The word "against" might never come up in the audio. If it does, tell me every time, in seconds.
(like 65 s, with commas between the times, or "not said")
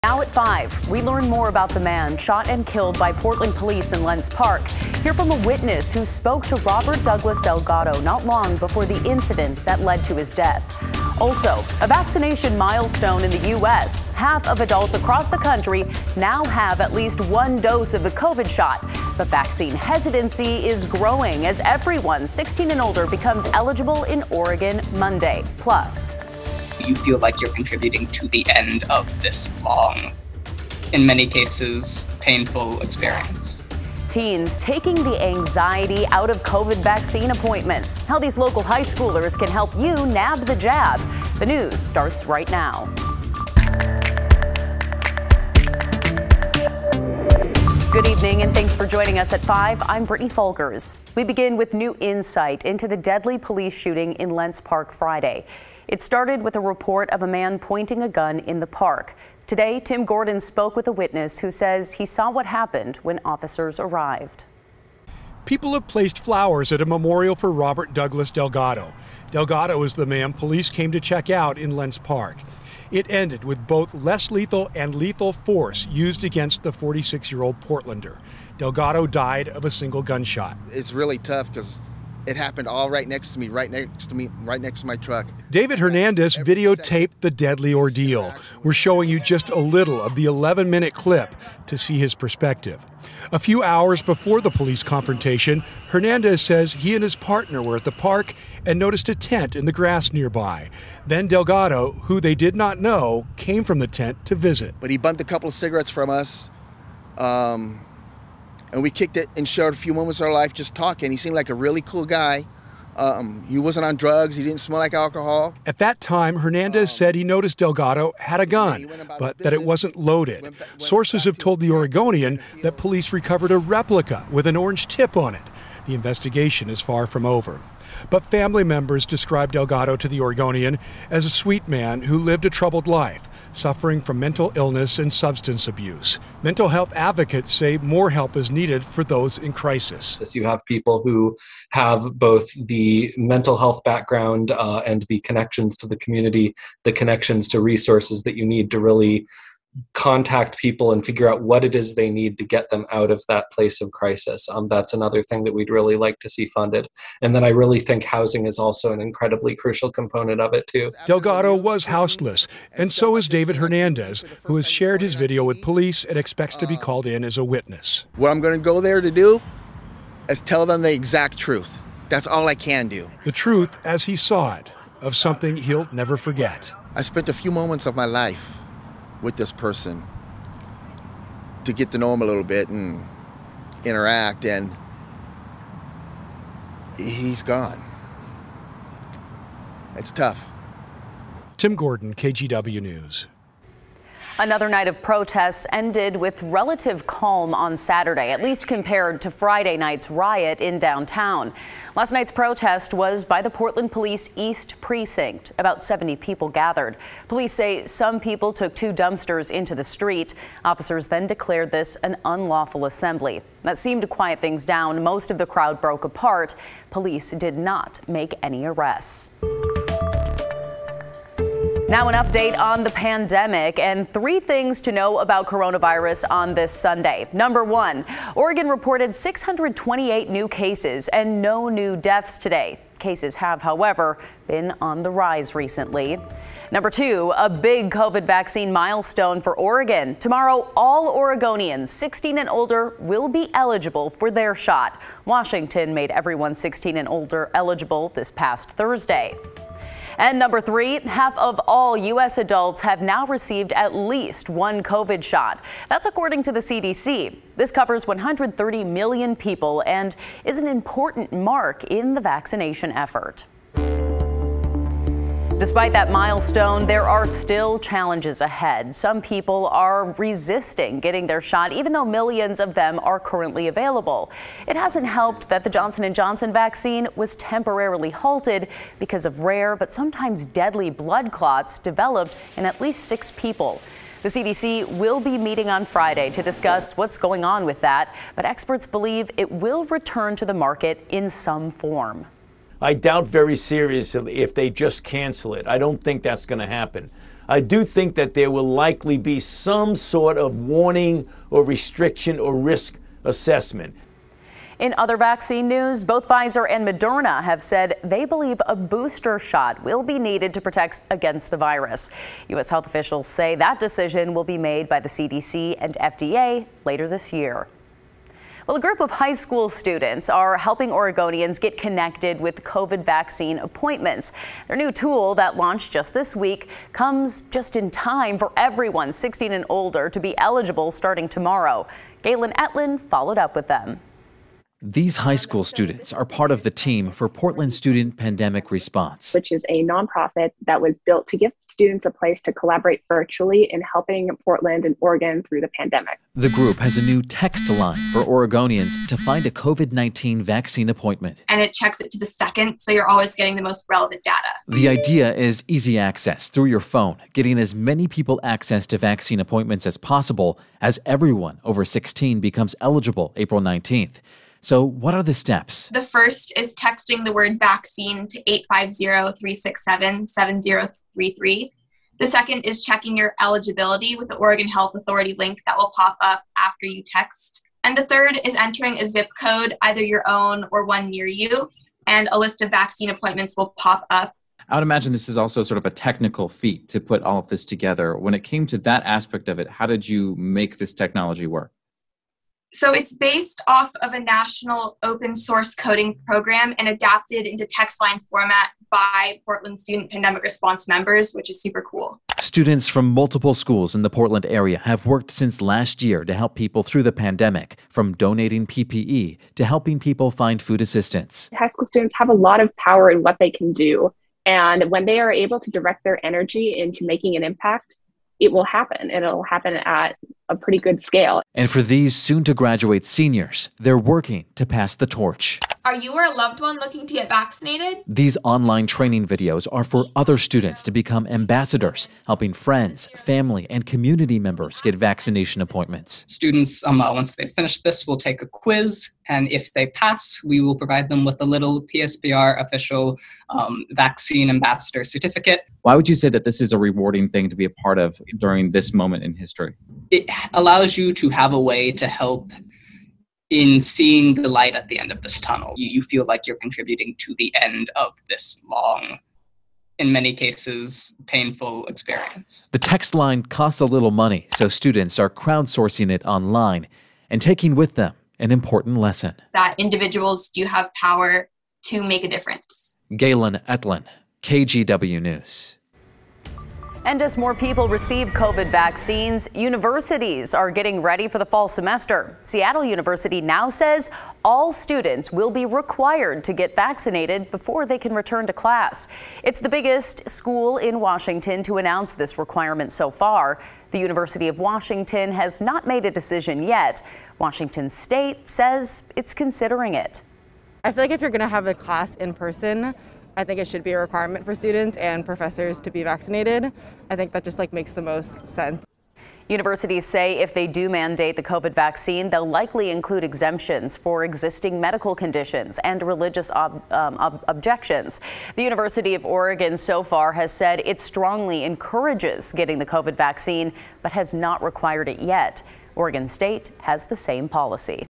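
76 s, 311 s.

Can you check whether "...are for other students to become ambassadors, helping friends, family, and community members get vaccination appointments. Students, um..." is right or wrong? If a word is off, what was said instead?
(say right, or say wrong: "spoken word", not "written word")
right.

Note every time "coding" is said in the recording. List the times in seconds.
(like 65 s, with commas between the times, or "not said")
395 s.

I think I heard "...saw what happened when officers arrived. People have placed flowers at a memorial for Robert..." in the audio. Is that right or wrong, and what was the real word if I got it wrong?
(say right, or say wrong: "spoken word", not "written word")
right.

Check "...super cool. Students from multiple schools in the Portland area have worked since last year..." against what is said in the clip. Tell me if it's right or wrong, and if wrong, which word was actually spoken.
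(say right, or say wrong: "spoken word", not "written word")
right.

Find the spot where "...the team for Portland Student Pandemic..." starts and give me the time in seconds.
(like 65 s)
336 s.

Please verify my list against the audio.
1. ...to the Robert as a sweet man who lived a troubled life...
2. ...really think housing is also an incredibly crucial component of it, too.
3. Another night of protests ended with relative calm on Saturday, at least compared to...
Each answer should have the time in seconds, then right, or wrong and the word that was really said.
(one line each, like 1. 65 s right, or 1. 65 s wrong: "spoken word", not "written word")
1. 129 s wrong: "Oregonian", not "Robert"
2. 157 s right
3. 194 s right.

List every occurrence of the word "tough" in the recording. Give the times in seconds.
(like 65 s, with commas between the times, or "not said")
81 s, 190 s.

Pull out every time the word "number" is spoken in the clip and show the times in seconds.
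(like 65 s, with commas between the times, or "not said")
227 s, 236 s, 250 s.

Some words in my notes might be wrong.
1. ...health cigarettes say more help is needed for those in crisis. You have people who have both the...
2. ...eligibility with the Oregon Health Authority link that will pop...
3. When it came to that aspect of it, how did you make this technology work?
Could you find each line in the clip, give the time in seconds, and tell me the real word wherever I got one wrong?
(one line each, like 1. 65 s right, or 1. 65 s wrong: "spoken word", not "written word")
1. 136 s wrong: "advocates", not "cigarettes"
2. 373 s right
3. 388 s right.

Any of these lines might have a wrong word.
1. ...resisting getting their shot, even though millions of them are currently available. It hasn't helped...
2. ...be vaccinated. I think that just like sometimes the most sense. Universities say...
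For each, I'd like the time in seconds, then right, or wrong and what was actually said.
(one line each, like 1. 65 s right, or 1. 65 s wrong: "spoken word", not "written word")
1. 270 s right
2. 505 s wrong: "makes", not "sometimes".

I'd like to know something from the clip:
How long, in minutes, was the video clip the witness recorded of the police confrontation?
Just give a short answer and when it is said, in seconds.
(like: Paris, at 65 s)
11 minutes, at 90 s.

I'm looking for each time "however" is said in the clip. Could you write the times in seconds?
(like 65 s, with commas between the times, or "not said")
233 s.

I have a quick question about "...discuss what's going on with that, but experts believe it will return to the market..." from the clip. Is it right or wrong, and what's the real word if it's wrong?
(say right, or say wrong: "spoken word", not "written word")
right.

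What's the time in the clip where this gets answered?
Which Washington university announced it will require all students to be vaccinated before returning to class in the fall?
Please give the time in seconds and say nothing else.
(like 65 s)
482 s.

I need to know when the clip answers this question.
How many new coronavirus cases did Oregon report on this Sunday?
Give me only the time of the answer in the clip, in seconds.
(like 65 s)
229 s.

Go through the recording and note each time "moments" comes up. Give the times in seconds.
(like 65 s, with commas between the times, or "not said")
109 s, 177 s, 448 s.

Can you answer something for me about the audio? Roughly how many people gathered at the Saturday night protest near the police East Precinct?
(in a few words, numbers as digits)
About 70.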